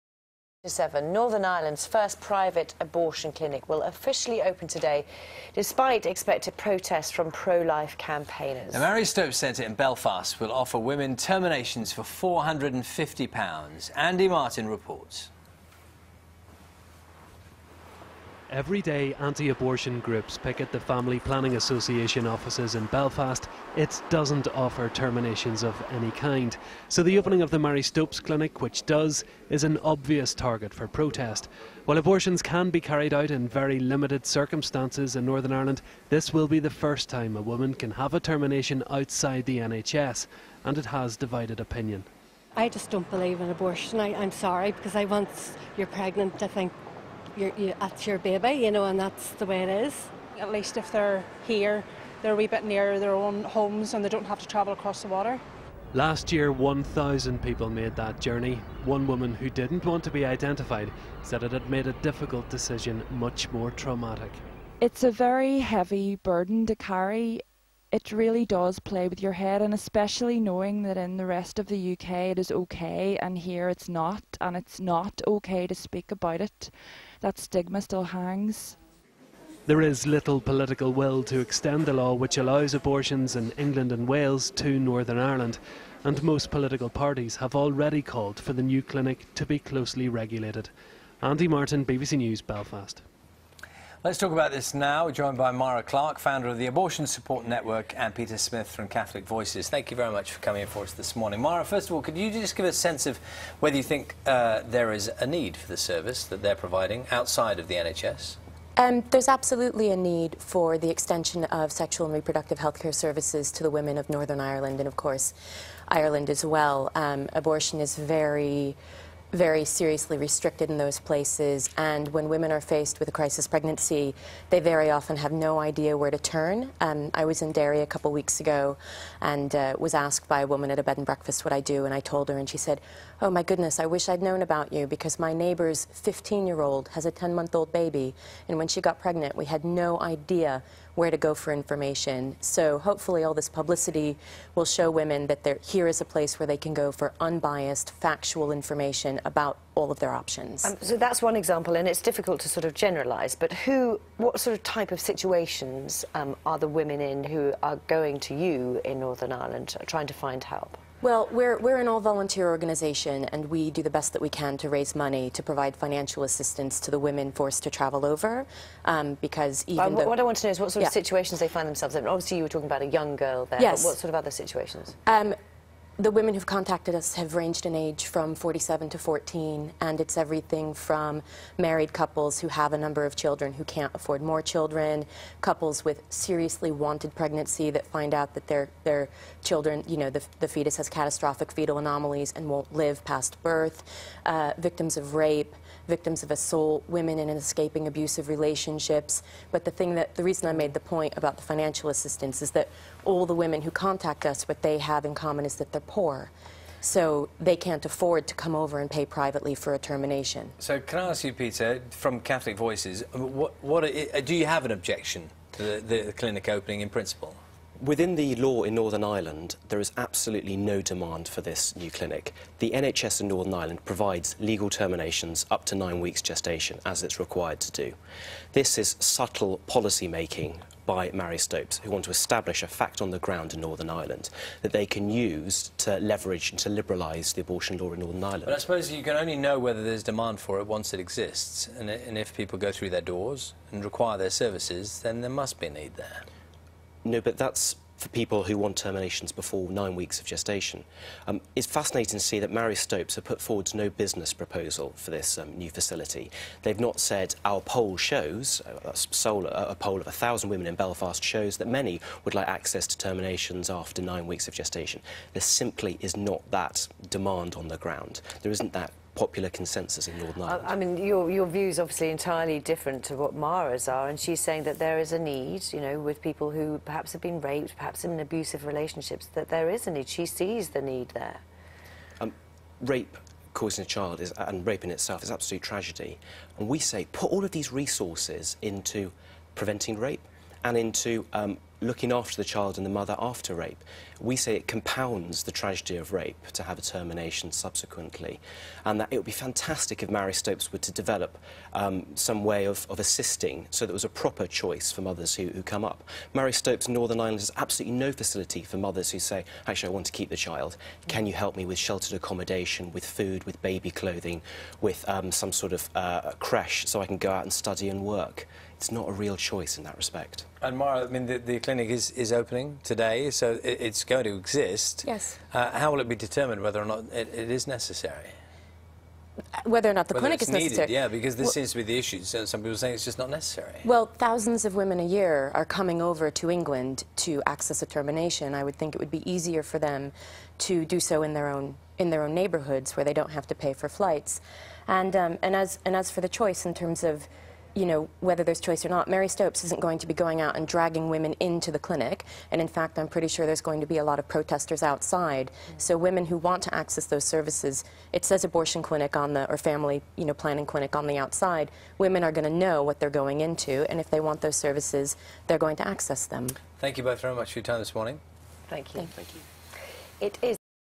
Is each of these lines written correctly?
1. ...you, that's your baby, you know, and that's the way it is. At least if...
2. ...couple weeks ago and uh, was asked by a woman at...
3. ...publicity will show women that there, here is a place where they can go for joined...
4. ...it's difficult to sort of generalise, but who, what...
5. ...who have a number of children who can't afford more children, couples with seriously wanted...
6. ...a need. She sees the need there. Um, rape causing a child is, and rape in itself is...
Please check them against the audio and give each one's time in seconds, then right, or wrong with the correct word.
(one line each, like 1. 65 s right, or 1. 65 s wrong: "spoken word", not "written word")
1. 47 s right
2. 127 s right
3. 143 s wrong: "unbiased", not "joined"
4. 151 s right
5. 182 s right
6. 279 s right.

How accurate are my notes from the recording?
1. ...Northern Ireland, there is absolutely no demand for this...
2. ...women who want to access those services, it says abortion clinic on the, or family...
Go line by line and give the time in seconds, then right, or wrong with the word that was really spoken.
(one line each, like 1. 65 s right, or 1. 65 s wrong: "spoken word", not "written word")
1. 218 s right
2. 355 s right.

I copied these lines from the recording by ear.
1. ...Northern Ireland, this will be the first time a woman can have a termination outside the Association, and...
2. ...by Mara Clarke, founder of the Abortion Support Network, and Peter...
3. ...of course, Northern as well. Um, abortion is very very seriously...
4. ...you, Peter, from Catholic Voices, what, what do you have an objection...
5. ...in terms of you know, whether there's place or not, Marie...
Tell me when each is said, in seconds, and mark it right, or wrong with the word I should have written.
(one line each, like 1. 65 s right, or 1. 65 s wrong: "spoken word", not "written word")
1. 35 s wrong: "NHS", not "Association"
2. 95 s right
3. 114 s wrong: "Ireland", not "Northern"
4. 211 s right
5. 346 s wrong: "choice", not "place".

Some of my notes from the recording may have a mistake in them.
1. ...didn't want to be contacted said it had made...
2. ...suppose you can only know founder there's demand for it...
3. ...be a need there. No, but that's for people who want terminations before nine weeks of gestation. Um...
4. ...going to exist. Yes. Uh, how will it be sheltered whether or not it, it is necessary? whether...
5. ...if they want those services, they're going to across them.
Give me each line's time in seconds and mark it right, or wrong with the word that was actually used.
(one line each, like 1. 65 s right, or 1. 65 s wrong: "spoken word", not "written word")
1. 59 s wrong: "identified", not "contacted"
2. 238 s wrong: "whether", not "founder"
3. 245 s right
4. 324 s wrong: "determined", not "sheltered"
5. 363 s wrong: "access", not "across".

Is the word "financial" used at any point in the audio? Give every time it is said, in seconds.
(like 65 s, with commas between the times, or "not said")
165 s, 201 s.